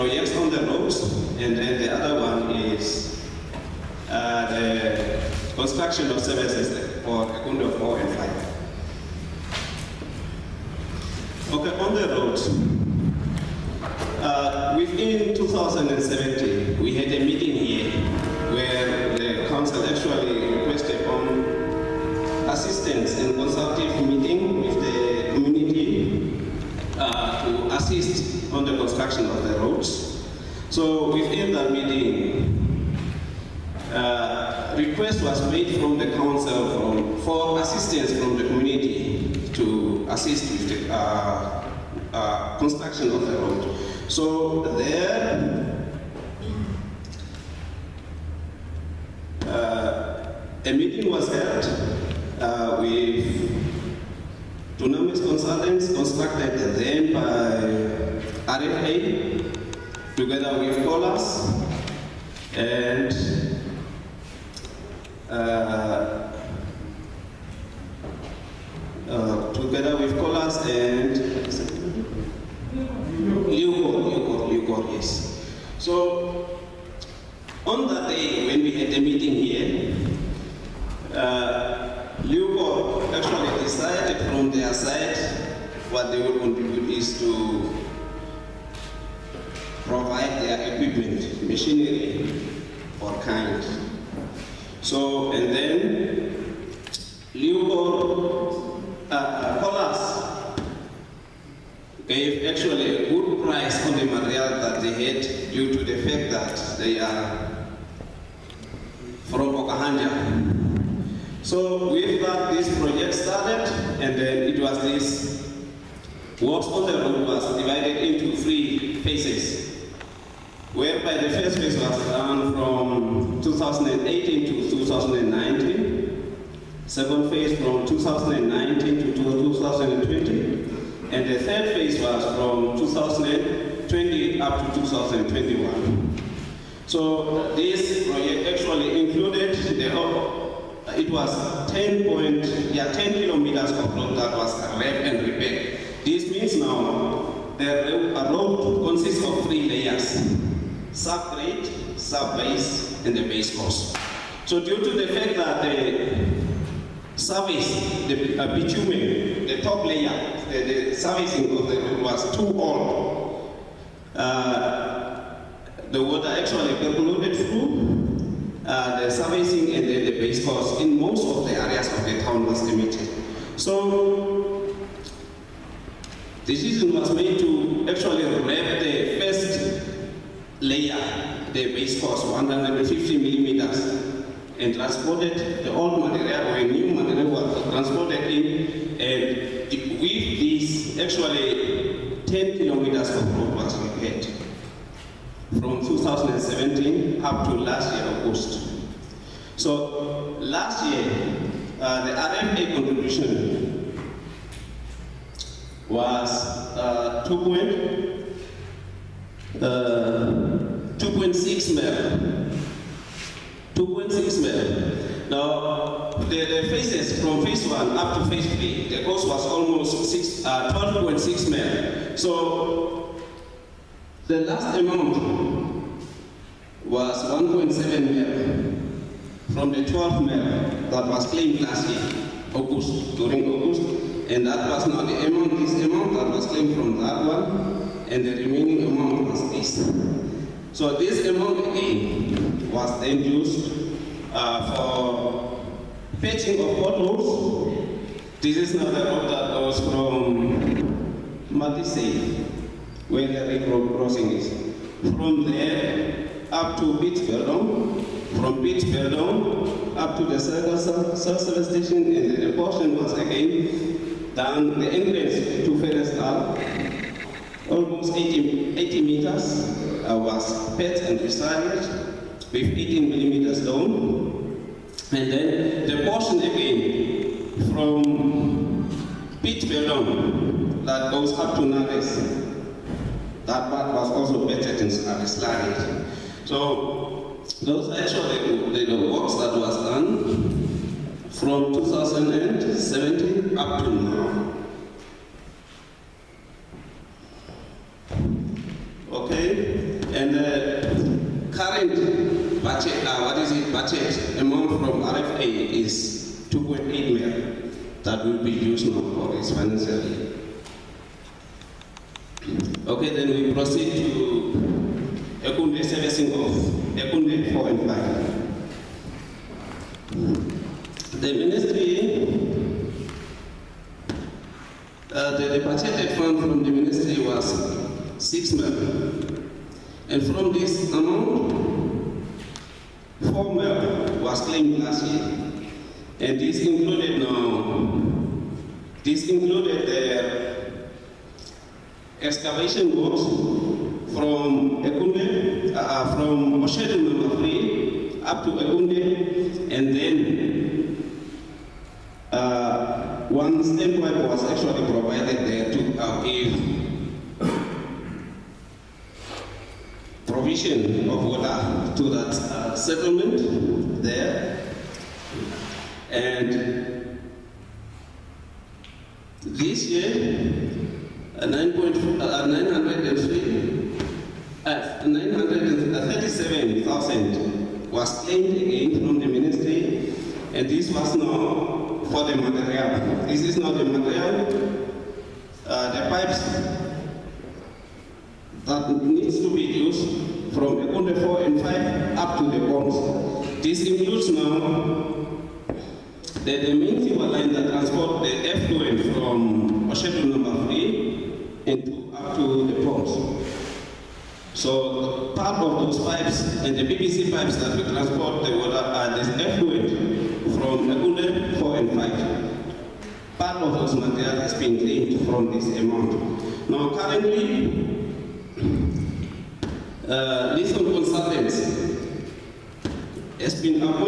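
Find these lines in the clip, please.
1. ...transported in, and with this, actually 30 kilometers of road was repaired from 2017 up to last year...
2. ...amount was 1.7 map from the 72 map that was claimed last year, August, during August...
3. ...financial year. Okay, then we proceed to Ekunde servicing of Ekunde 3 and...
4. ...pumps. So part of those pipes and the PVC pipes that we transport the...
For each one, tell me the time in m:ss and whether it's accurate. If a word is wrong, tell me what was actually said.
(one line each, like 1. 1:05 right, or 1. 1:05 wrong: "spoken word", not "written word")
1. 3:07 wrong: "10", not "30"
2. 3:44 wrong: "12", not "72"
3. 5:09 wrong: "4", not "3"
4. 6:42 right.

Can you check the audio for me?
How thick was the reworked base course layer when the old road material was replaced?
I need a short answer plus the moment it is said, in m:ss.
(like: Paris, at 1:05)
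150 millimeters, at 3:02.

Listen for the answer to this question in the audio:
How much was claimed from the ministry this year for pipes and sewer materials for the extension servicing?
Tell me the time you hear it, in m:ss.
6:11.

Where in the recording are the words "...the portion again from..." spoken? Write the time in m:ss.
4:35.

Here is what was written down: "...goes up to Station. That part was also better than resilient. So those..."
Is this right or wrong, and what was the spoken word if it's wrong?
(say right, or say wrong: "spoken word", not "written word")
wrong: "Nares", not "Station".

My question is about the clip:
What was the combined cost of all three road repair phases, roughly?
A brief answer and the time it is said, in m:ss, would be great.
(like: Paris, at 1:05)
12.6 million, at 3:40.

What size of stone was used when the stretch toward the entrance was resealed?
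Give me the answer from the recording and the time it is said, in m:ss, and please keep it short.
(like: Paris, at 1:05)
18 millimeters, at 4:32.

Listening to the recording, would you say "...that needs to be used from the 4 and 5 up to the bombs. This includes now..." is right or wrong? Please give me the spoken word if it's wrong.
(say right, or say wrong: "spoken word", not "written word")
right.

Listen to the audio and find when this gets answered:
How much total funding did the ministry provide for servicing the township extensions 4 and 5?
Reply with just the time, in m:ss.
5:28.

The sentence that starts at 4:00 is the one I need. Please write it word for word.
So this amount A was then used uh, for fetching of bottles.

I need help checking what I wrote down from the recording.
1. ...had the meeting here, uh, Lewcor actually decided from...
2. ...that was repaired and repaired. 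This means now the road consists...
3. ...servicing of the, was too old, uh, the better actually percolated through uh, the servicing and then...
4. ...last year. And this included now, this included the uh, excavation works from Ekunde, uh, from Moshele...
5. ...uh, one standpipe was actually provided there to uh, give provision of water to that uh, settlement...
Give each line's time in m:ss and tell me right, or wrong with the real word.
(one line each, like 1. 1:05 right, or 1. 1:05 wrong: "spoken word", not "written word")
1. 1:18 right
2. 2:24 right
3. 2:40 wrong: "water", not "better"
4. 5:34 right
5. 5:52 right.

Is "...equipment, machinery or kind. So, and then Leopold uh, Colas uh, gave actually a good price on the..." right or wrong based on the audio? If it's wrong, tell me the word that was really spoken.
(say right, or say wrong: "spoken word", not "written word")
right.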